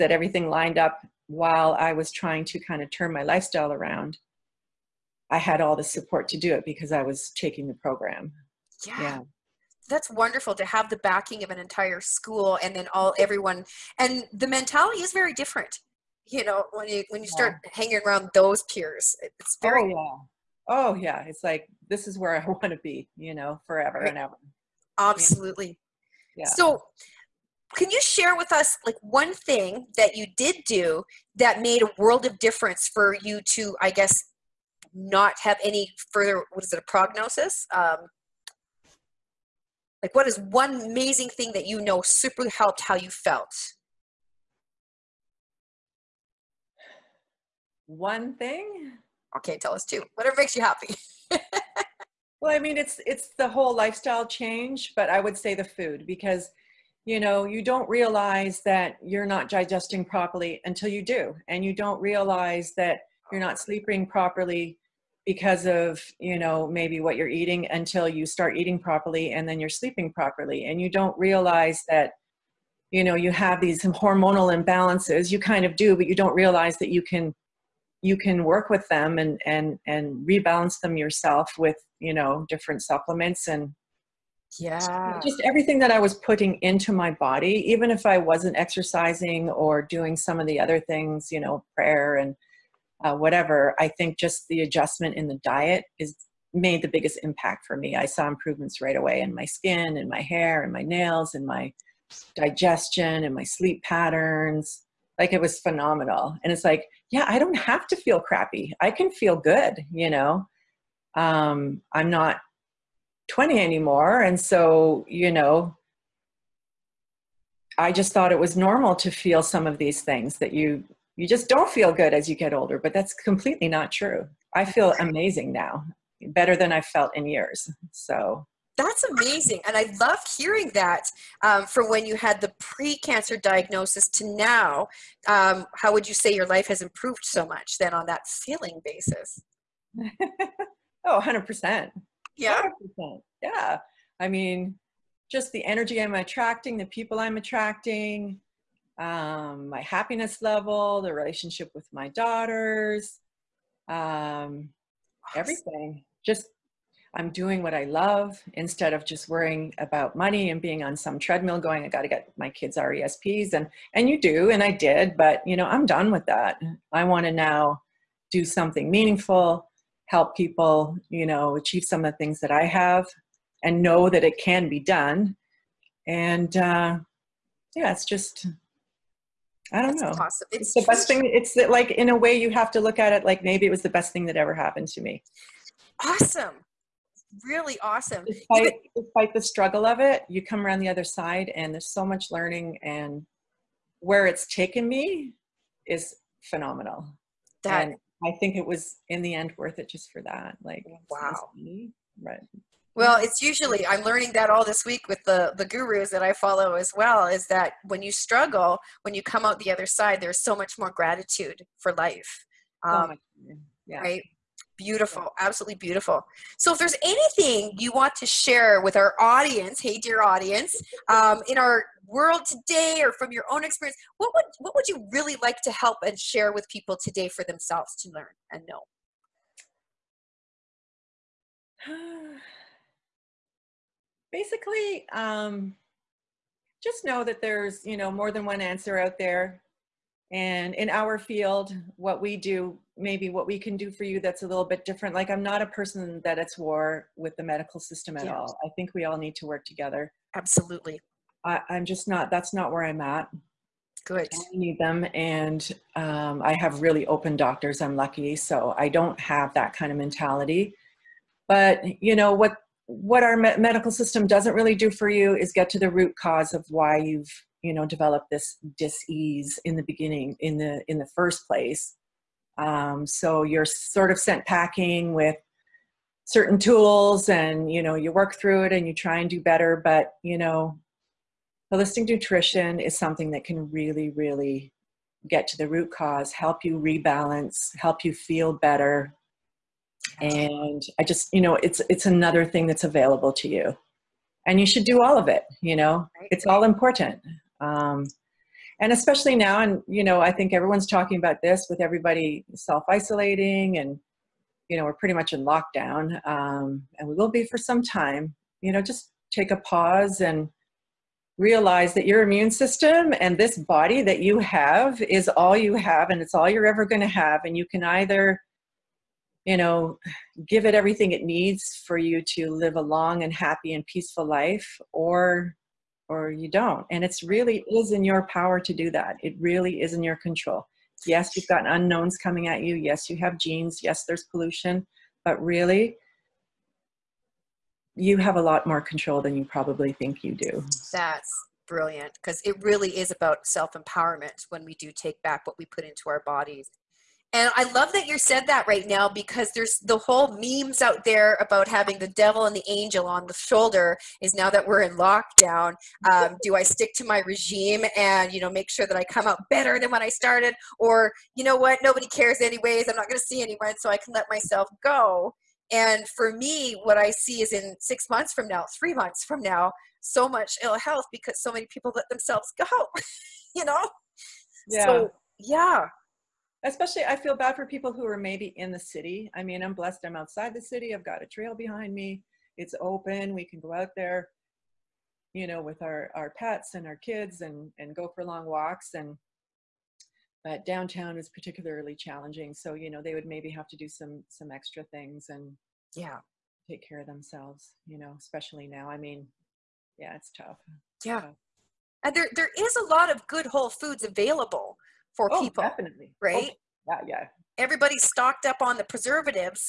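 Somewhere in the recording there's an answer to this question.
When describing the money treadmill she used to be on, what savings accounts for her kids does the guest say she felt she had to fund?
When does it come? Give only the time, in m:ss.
2:42.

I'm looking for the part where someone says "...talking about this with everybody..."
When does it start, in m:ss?
5:00.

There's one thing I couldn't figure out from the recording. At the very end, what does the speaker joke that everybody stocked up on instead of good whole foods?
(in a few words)
preservatives.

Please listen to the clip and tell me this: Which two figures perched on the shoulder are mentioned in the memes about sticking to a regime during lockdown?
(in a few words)
the devil and the angel.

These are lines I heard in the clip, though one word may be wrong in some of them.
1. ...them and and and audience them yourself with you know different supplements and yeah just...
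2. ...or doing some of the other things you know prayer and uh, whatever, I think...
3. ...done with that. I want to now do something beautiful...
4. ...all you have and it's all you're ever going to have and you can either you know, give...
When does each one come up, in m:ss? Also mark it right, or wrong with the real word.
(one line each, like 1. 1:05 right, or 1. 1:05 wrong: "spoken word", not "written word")
1. 1:18 wrong: "rebalance", not "audience"
2. 1:29 right
3. 2:45 wrong: "meaningful", not "beautiful"
4. 5:15 right.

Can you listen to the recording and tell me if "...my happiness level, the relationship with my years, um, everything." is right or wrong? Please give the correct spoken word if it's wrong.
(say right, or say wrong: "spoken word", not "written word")
wrong: "daughters", not "years".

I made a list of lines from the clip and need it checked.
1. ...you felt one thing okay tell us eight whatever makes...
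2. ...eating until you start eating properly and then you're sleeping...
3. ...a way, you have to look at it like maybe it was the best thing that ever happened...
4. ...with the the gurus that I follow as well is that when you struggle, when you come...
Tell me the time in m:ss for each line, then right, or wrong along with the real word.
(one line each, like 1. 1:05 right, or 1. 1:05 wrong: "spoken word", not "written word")
1. 0:42 wrong: "two", not "eight"
2. 1:07 right
3. 3:02 right
4. 3:25 right.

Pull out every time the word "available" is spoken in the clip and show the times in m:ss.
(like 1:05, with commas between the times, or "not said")
4:52, 6:44.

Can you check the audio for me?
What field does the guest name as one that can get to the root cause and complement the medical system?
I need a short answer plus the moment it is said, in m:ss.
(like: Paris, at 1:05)
holistic nutrition, at 4:41.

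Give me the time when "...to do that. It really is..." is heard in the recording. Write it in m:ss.
5:28.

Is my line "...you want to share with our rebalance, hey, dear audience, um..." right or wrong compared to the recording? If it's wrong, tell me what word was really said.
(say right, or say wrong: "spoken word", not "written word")
wrong: "audience", not "rebalance".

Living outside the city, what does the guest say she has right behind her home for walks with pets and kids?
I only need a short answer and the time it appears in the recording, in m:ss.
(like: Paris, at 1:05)
a trail, at 6:21.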